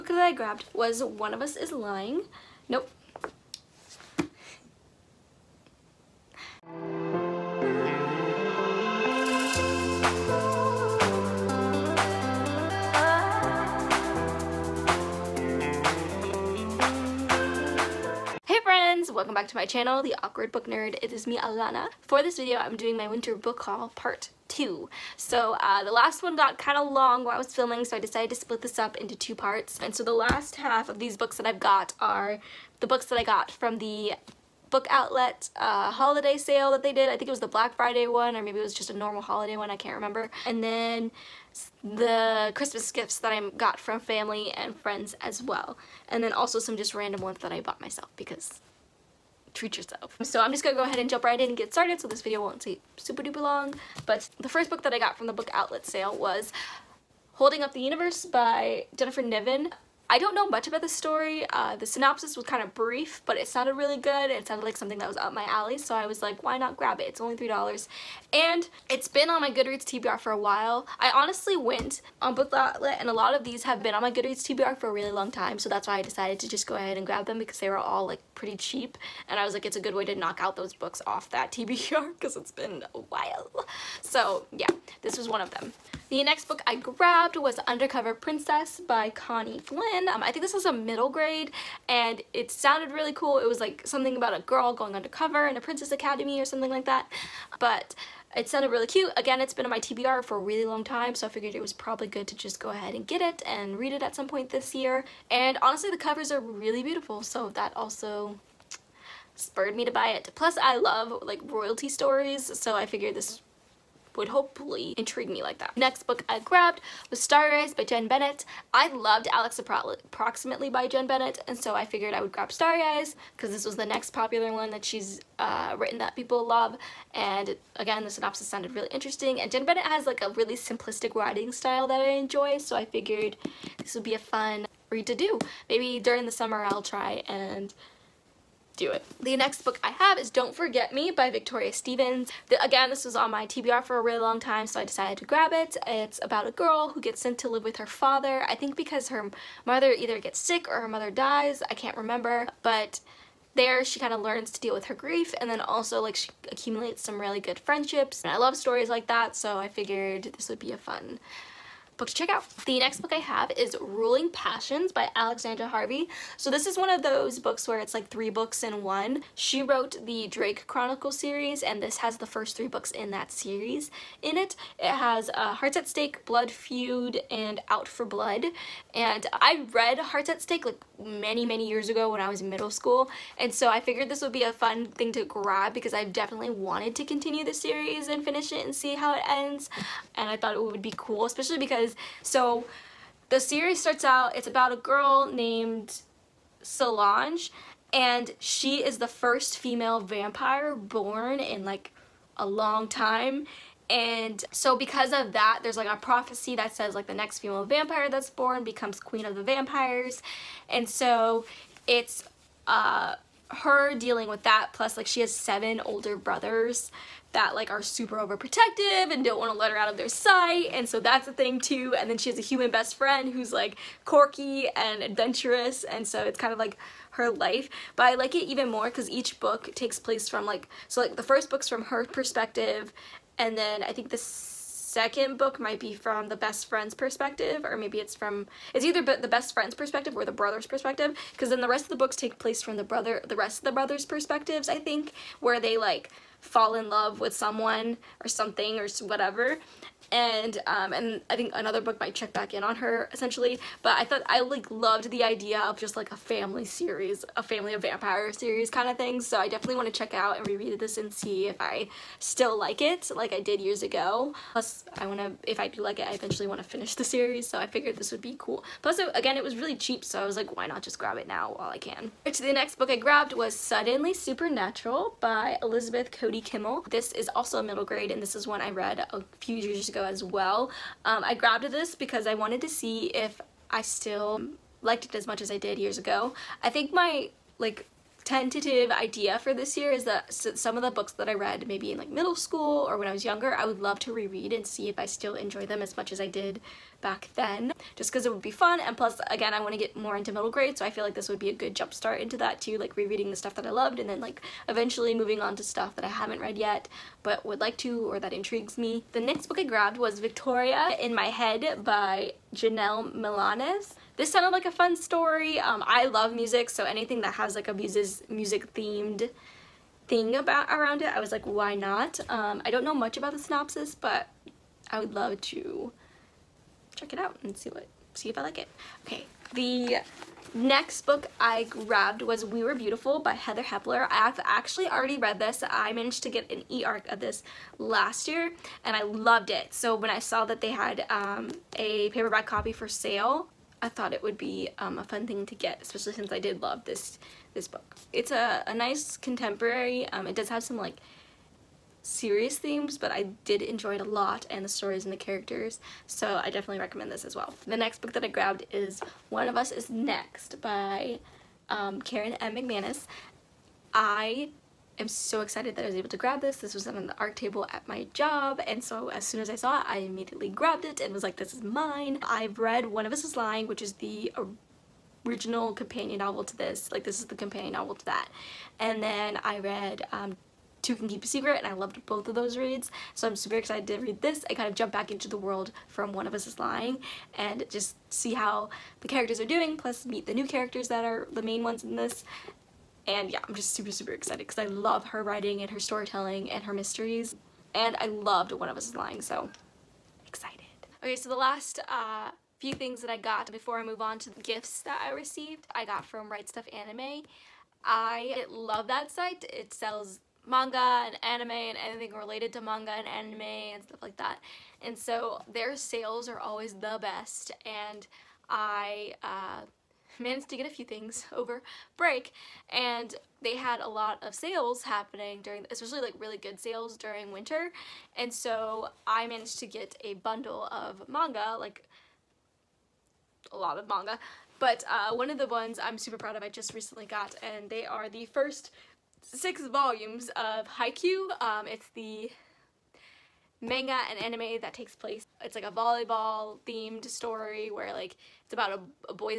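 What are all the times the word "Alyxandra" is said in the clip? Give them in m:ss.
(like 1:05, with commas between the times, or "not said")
2:45.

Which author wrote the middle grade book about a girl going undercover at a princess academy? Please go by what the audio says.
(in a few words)
Connie Glynn.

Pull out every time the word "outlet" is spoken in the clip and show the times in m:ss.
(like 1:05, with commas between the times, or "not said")
0:34, 0:55, 1:12.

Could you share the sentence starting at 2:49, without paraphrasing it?
She wrote the Drake Chronicle series and this has the first three books in that series in it.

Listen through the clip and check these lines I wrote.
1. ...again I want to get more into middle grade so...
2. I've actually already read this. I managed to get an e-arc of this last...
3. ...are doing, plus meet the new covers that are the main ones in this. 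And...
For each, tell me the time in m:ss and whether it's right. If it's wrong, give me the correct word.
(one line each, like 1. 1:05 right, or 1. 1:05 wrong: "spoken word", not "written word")
1. 4:59 right
2. 5:34 right
3. 6:29 wrong: "characters", not "covers".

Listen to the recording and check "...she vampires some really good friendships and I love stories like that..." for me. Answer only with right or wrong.
wrong.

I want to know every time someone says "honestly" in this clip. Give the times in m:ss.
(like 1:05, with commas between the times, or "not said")
1:11, 1:45.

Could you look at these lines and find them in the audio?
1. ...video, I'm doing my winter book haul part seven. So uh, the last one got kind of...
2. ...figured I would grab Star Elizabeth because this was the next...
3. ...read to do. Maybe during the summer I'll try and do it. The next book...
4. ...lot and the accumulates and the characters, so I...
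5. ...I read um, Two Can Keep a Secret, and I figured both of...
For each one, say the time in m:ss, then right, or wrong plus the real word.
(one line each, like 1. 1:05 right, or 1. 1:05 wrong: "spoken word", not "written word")
1. 0:22 wrong: "two", not "seven"
2. 2:01 wrong: "Eyes", not "Elizabeth"
3. 2:14 right
4. 5:54 wrong: "stories", not "accumulates"
5. 6:19 wrong: "loved", not "figured".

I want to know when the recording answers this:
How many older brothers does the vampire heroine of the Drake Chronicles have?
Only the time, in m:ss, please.
3:35.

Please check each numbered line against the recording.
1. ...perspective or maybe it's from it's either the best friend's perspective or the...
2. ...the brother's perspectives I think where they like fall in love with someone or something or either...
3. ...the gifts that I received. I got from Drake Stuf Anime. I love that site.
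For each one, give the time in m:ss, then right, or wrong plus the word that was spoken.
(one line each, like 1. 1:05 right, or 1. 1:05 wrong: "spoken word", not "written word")
1. 3:56 right
2. 4:03 wrong: "whatever", not "either"
3. 6:44 wrong: "Right", not "Drake".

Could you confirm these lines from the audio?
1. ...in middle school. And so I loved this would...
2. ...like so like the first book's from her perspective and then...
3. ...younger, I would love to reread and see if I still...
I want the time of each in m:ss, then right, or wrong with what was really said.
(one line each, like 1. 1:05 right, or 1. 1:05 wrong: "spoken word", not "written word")
1. 3:02 wrong: "figured", not "loved"
2. 3:50 right
3. 4:53 right.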